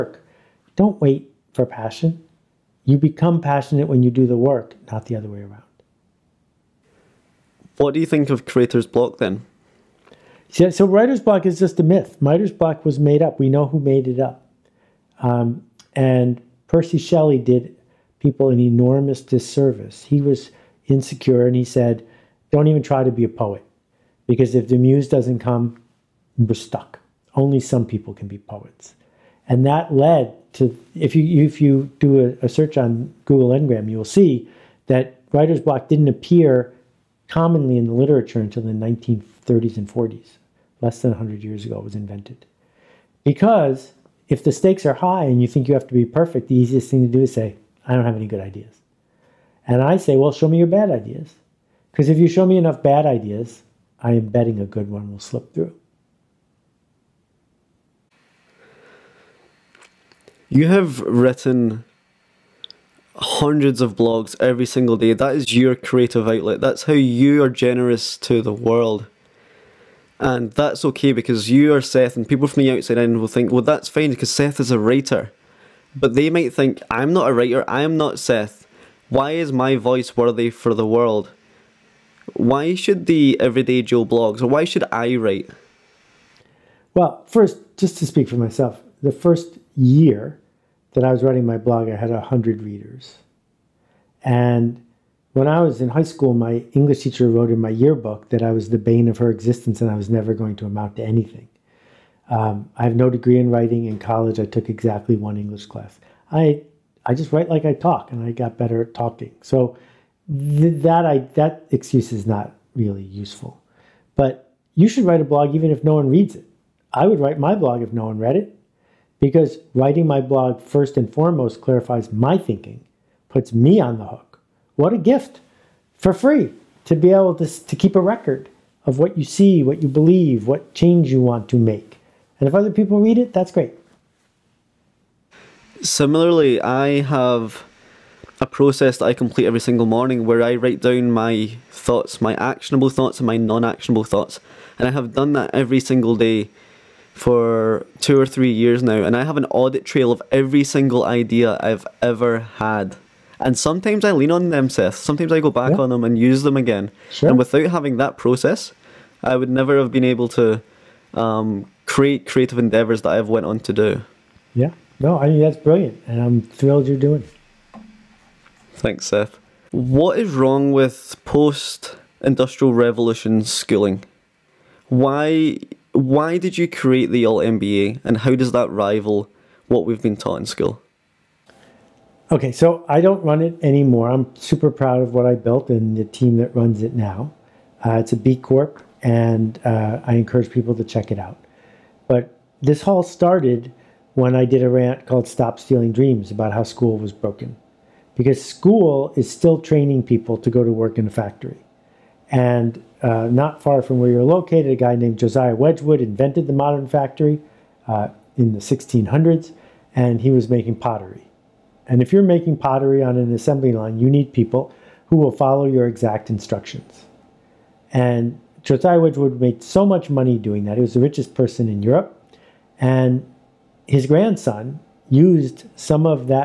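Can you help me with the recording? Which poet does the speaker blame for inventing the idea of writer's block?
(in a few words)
Percy Shelley.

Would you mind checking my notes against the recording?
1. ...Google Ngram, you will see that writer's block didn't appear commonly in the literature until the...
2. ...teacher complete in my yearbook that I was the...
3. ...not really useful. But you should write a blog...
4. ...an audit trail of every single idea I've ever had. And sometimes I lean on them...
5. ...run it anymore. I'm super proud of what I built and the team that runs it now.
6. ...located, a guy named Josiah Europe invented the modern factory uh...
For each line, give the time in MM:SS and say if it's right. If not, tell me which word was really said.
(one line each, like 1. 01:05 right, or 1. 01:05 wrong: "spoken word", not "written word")
1. 00:33 right
2. 01:37 wrong: "wrote", not "complete"
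3. 01:52 right
4. 02:29 right
5. 03:03 right
6. 03:24 wrong: "Wedgwood", not "Europe".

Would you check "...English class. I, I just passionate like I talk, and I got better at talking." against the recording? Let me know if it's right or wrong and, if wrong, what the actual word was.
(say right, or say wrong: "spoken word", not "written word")
wrong: "write", not "passionate".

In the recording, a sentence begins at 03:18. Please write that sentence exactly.
Because school is still training people to go to work in a factory.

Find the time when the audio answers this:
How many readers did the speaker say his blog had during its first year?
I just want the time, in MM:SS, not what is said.
01:32.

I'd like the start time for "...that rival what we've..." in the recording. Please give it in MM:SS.
02:58.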